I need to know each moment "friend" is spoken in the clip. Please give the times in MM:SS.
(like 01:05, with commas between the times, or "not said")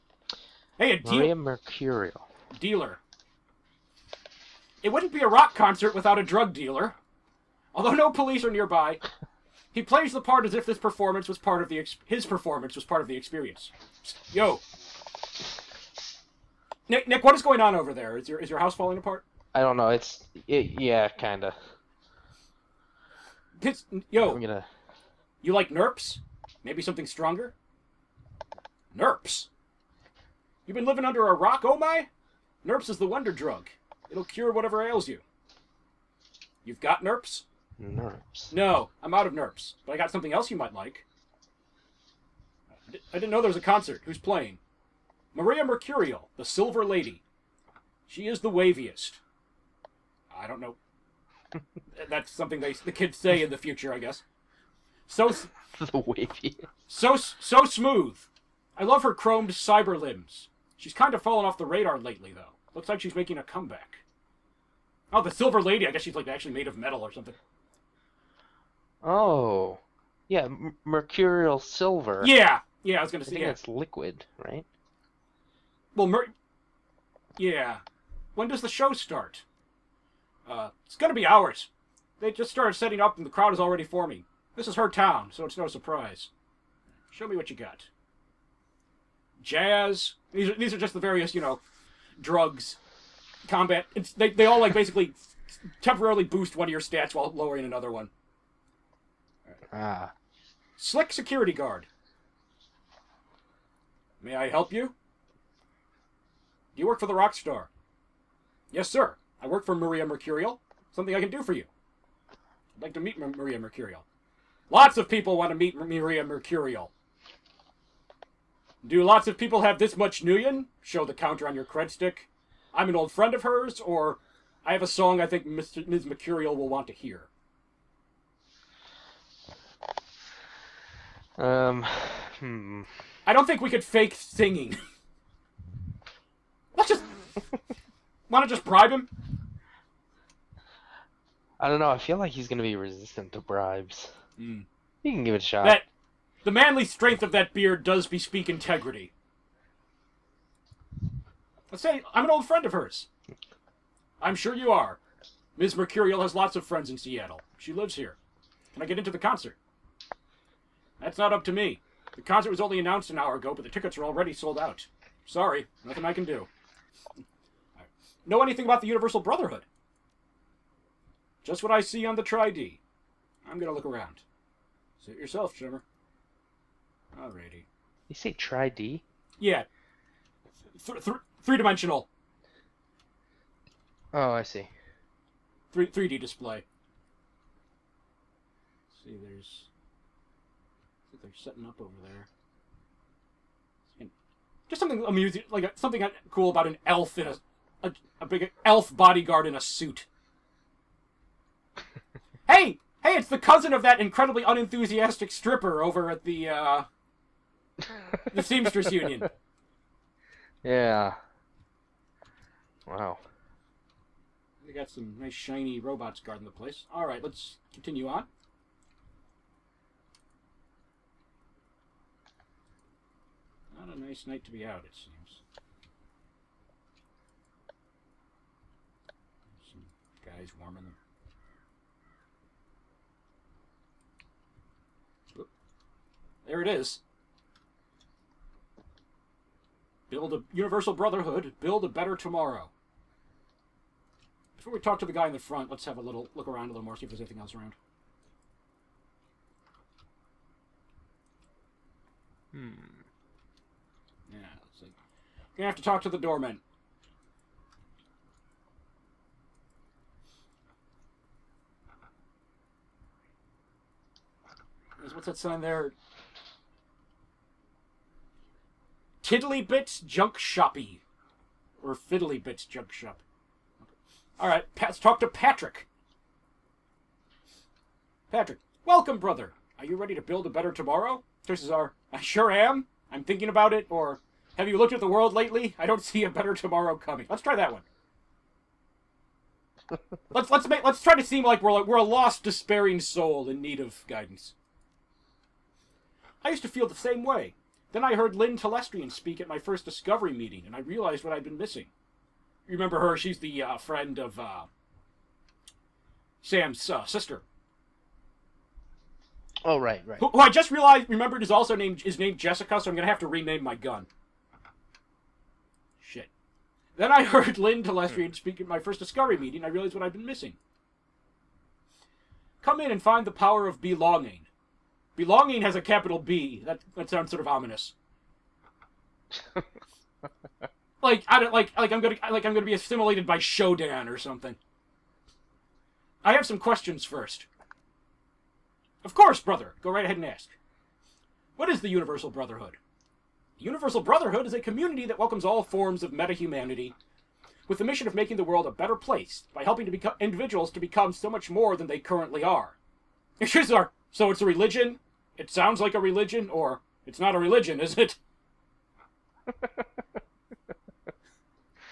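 02:03, 02:32, 02:36, 05:03.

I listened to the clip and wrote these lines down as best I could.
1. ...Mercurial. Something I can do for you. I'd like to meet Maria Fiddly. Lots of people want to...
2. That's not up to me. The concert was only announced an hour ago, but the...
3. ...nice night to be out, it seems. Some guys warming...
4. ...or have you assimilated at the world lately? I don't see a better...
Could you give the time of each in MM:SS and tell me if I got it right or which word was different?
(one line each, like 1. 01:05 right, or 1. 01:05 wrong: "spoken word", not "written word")
1. 01:50 wrong: "Mercurial", not "Fiddly"
2. 02:40 right
3. 03:43 right
4. 04:43 wrong: "looked", not "assimilated".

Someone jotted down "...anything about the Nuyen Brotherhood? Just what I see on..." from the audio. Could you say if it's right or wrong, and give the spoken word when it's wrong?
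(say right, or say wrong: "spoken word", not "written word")
wrong: "Universal", not "Nuyen".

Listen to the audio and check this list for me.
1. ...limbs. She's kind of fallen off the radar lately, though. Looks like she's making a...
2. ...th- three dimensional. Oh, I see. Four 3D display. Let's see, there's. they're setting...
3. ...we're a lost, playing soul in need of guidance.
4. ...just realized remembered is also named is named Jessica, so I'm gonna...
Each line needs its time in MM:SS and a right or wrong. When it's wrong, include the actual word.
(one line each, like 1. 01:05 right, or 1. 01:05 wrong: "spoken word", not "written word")
1. 00:59 right
2. 03:01 wrong: "Three", not "Four"
3. 04:51 wrong: "despairing", not "playing"
4. 05:10 right.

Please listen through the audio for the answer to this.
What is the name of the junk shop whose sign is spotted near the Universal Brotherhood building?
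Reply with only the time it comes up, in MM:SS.
04:31.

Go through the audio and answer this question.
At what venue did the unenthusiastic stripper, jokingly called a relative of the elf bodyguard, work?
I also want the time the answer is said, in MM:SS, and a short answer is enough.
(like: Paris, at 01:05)
The Seamstress Union, at 03:28.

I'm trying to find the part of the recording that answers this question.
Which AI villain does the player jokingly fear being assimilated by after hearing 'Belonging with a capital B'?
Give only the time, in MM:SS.
05:33.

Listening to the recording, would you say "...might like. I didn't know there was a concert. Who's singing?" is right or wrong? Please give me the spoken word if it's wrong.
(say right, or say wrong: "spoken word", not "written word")
wrong: "playing", not "singing".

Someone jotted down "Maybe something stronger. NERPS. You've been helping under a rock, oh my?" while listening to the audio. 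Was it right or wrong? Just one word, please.
wrong.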